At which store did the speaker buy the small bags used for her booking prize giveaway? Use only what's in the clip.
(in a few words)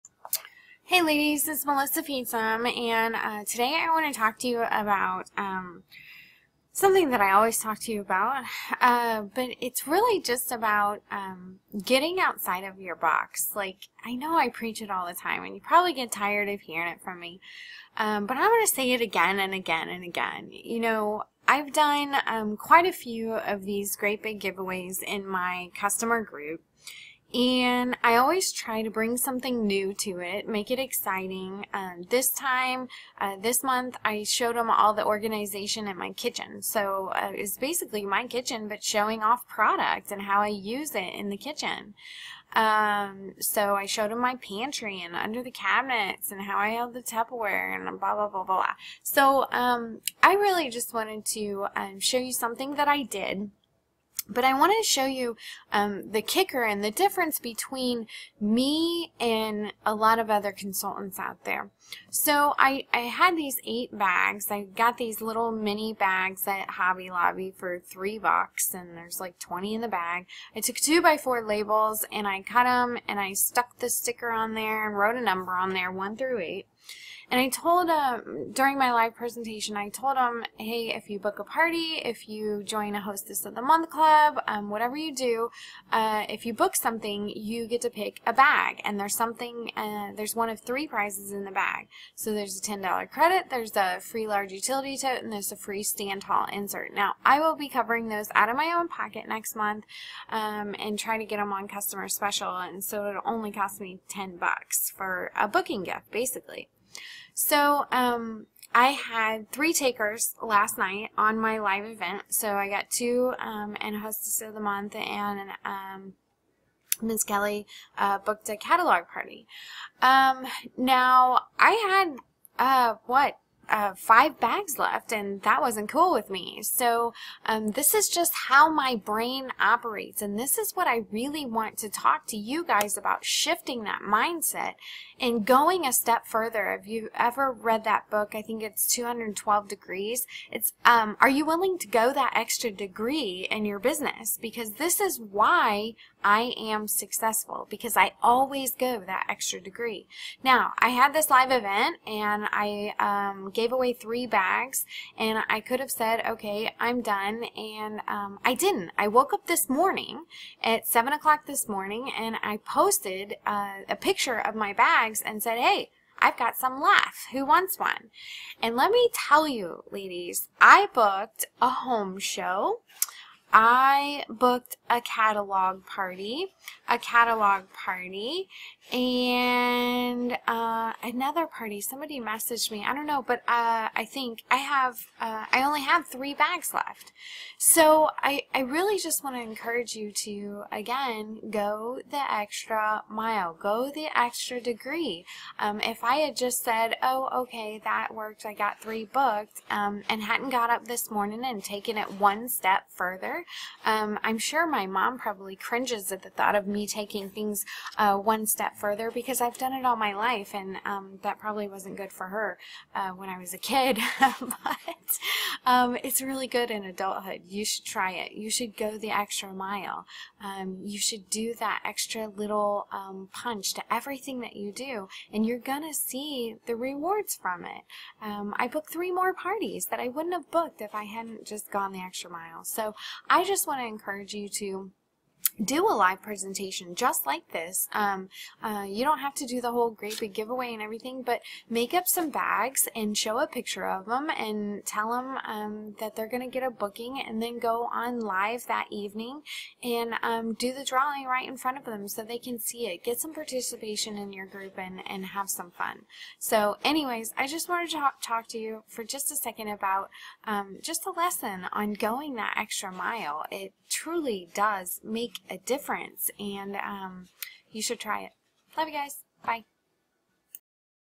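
Hobby Lobby.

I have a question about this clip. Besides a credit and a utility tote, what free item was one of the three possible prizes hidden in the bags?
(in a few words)
stand tall insert.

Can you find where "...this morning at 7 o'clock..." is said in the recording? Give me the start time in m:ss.
2:39.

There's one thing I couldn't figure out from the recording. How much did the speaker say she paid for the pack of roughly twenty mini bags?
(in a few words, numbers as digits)
3 dollars.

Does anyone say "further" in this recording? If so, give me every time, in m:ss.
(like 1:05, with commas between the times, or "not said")
2:16, 3:22, 3:28.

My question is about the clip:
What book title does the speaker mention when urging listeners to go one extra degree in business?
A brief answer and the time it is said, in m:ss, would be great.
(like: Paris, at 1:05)
212 degrees, at 2:18.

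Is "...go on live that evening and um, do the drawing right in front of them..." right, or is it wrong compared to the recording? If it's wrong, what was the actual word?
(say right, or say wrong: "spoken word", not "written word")
right.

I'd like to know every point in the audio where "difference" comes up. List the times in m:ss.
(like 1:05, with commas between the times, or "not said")
0:56, 4:25.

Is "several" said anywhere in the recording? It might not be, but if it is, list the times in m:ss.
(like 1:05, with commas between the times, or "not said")
not said.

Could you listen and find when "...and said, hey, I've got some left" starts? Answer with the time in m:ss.
2:45.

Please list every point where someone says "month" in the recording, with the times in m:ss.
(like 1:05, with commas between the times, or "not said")
0:33, 1:23, 1:39, 1:54.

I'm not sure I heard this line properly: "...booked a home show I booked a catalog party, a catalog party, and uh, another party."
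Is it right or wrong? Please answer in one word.
right.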